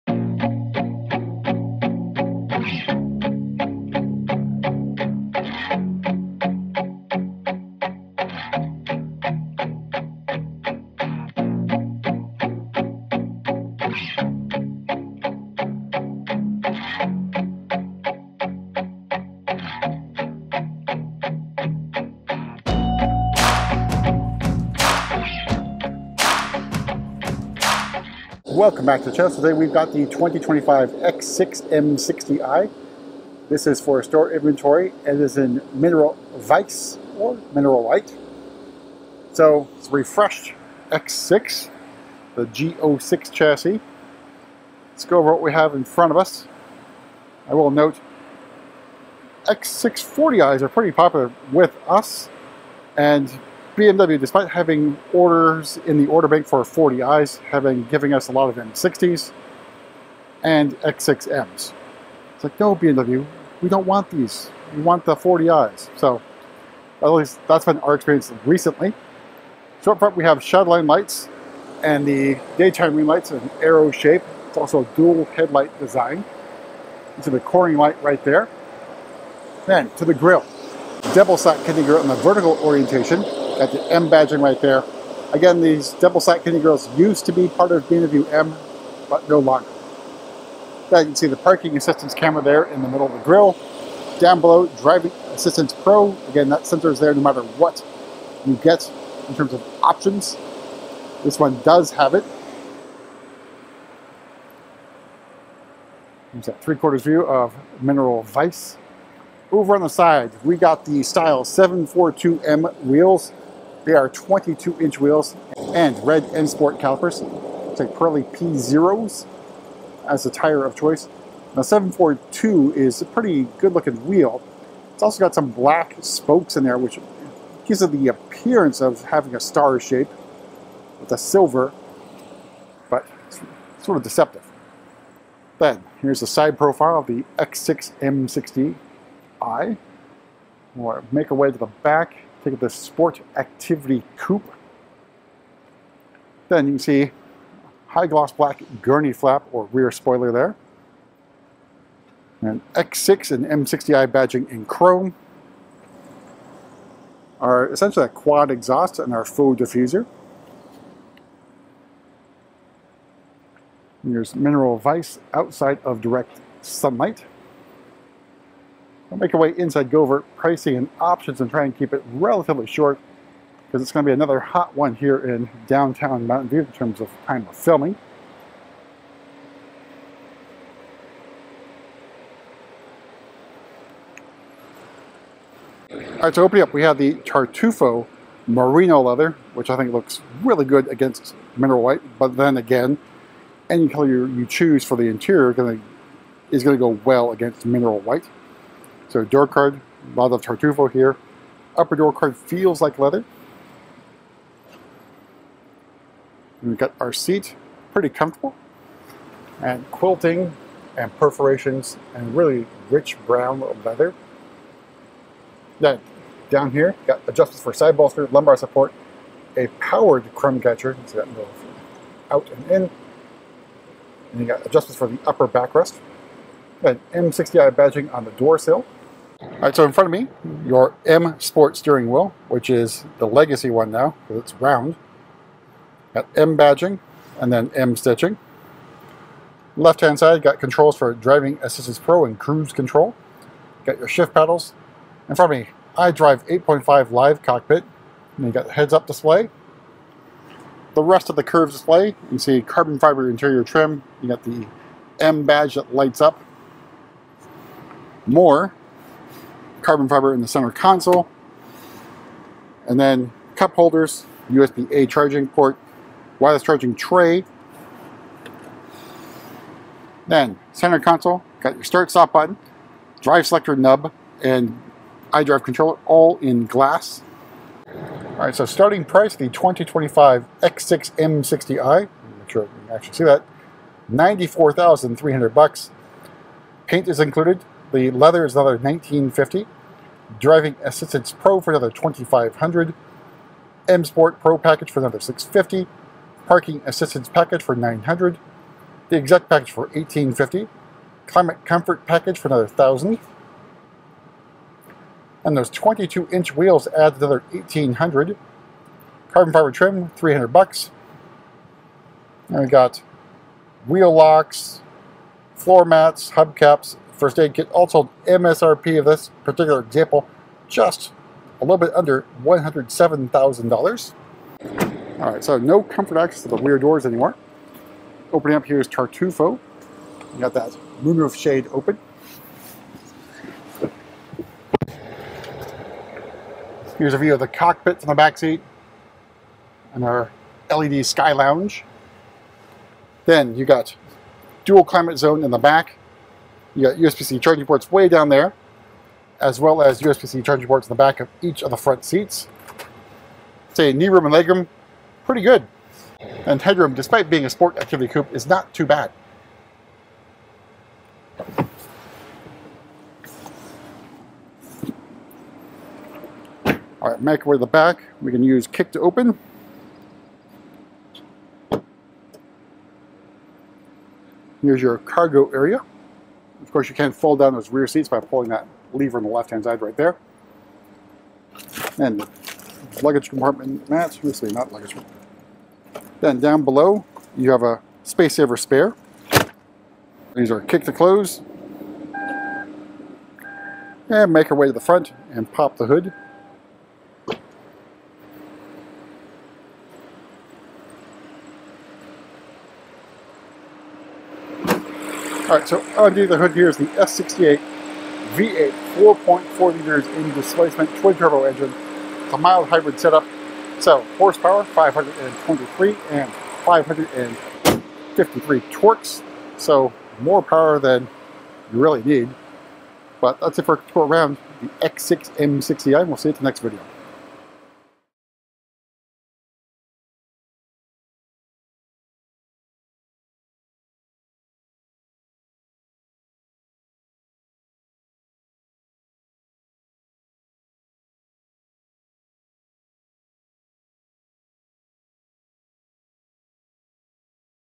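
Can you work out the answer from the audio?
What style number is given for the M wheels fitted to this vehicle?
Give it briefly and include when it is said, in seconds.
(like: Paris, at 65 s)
742M, at 111 s.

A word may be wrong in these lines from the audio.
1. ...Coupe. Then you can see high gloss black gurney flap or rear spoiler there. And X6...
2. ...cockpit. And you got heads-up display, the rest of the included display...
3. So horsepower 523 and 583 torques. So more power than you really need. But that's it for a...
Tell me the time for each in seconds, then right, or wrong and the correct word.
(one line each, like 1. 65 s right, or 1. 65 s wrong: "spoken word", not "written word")
1. 144 s right
2. 247 s wrong: "curved", not "included"
3. 413 s wrong: "553", not "583".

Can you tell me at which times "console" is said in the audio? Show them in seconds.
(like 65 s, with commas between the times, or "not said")
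260 s, 270 s.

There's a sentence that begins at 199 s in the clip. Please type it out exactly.
So door card, a lot of tartufo here.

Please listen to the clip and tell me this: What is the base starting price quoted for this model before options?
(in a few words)
$94,300.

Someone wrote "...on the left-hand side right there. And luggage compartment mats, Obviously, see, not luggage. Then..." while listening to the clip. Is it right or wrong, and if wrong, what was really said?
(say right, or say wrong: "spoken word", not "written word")
right.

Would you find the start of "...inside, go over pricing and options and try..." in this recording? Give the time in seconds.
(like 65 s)
169 s.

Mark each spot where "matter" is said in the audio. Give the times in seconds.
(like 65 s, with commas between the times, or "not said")
97 s.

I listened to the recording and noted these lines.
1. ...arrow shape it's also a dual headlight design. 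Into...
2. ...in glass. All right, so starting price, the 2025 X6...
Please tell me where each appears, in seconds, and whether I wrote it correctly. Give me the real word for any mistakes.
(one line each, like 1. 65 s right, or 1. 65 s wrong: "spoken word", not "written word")
1. 73 s right
2. 276 s right.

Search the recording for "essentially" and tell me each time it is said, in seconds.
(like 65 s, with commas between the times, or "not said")
157 s.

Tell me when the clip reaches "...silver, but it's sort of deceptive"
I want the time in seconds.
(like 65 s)
131 s.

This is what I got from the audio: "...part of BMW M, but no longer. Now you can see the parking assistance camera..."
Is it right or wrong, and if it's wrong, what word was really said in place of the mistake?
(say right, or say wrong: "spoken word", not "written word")
right.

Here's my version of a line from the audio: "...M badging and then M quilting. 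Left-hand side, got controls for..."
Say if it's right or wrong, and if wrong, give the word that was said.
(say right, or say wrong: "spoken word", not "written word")
wrong: "stitching", not "quilting".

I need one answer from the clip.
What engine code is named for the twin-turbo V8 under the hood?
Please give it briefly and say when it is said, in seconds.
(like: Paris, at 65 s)
S68, at 406 s.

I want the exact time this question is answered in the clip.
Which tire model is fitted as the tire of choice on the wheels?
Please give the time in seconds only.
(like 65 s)
117 s.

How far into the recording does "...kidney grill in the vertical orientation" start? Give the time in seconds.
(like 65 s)
81 s.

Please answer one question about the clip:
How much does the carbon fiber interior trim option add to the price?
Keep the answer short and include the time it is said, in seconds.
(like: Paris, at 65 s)
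$300, at 310 s.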